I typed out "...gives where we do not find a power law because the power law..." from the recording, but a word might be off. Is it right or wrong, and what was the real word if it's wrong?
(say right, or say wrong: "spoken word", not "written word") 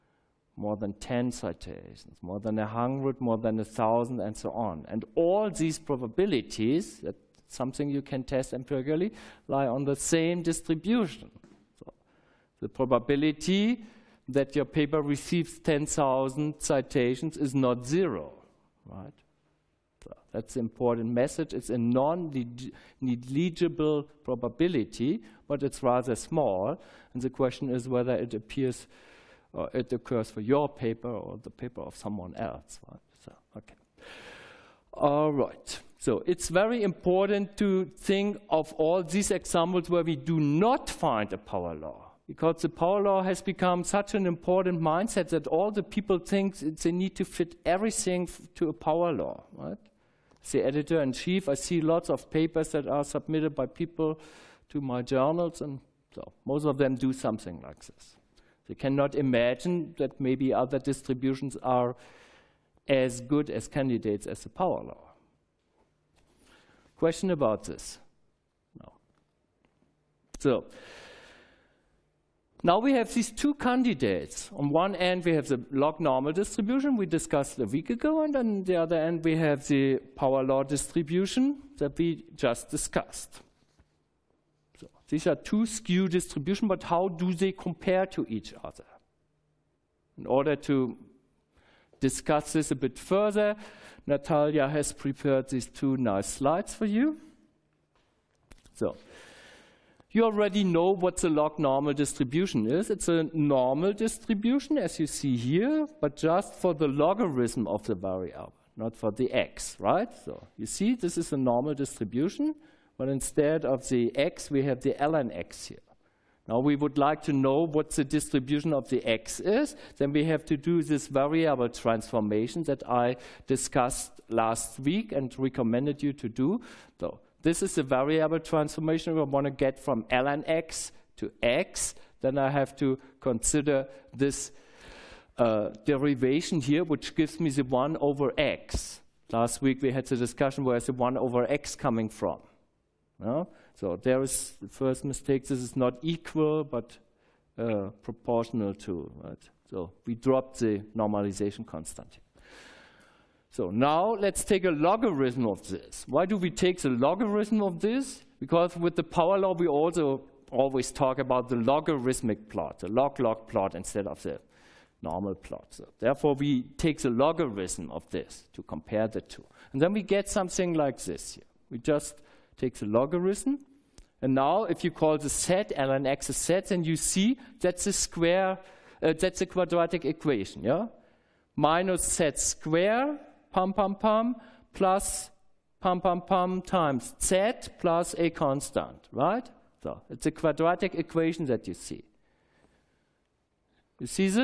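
wrong: "examples", not "gives".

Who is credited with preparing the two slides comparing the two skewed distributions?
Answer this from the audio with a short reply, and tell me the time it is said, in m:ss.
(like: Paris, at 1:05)
Natalia, at 1:34.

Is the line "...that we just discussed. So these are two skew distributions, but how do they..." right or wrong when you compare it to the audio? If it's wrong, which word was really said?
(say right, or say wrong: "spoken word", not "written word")
right.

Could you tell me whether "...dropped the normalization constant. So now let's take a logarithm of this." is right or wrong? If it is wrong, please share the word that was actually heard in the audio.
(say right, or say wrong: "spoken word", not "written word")
right.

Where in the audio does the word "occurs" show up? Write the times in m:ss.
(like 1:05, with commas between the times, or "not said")
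0:29.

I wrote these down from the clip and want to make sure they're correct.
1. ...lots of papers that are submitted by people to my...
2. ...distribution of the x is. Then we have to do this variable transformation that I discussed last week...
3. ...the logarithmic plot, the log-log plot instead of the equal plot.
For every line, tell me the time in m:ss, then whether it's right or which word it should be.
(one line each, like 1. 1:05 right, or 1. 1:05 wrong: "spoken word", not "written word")
1. 0:51 right
2. 1:58 right
3. 2:41 wrong: "normal", not "equal".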